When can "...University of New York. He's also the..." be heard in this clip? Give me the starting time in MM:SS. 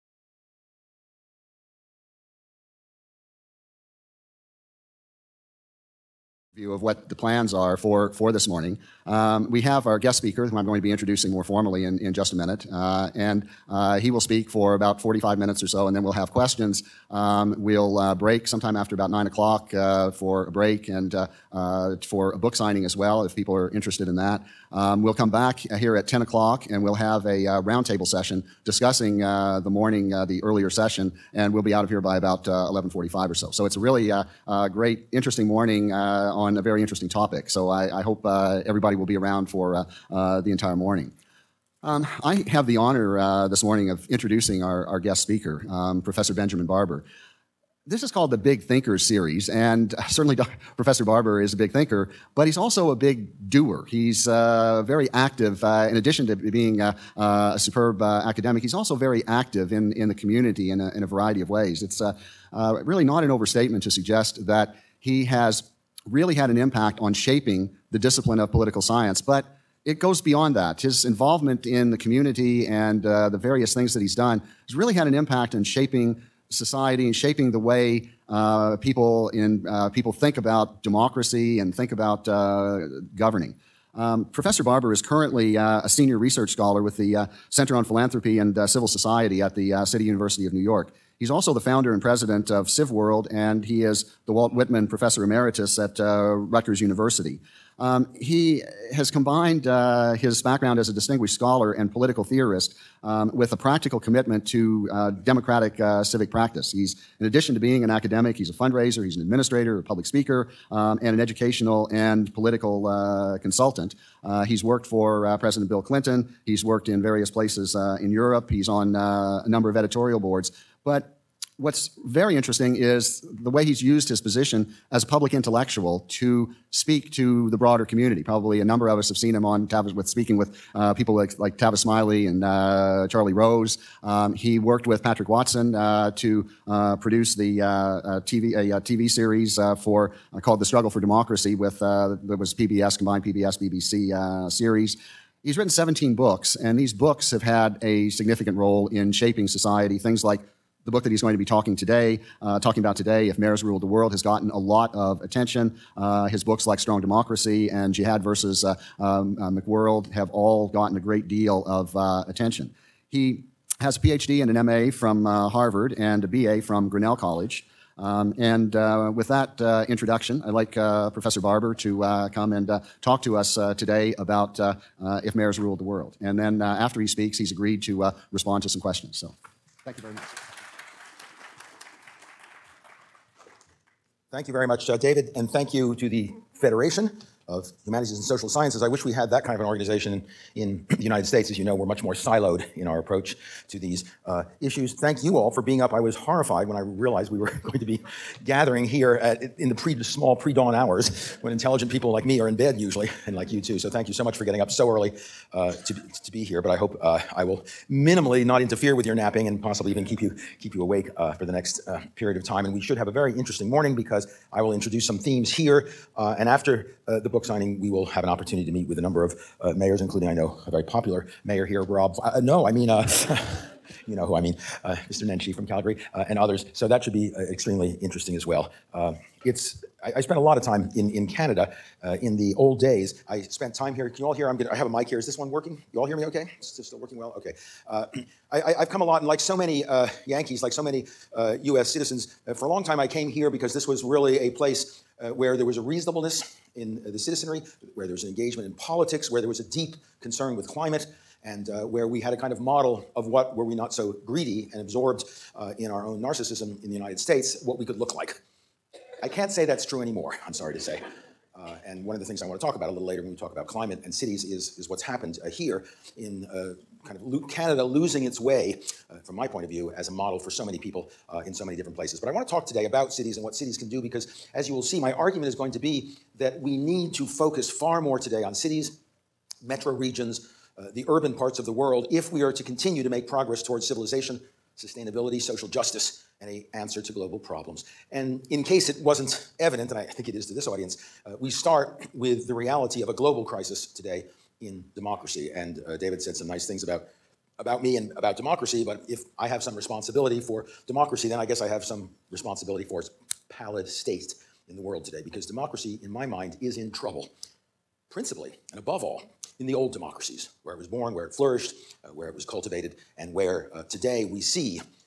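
01:30.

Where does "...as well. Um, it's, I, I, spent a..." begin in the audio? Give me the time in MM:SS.
03:48.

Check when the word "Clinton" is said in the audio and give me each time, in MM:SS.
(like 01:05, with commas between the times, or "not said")
01:55.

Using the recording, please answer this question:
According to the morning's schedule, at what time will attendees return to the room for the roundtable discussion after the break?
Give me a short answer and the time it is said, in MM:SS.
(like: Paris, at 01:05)
10 o'clock, at 00:26.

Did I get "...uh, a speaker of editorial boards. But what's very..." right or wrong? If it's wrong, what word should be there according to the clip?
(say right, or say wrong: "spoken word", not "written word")
wrong: "number", not "speaker".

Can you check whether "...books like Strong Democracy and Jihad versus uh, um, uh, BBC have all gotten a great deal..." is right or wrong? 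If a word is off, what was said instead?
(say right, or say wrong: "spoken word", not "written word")
wrong: "McWorld", not "BBC".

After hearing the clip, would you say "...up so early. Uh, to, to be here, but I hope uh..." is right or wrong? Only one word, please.
right.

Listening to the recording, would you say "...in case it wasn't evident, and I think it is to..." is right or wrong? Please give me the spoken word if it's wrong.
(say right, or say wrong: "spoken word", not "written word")
right.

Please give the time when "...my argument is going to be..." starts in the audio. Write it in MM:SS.
04:34.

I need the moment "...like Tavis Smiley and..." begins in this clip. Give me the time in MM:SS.
02:11.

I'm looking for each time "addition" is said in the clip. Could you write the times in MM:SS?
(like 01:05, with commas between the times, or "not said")
00:55, 01:47.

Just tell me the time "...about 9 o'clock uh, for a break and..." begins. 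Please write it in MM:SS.
00:18.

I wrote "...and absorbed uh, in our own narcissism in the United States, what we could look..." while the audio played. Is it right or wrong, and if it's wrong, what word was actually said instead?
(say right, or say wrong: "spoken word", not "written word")
right.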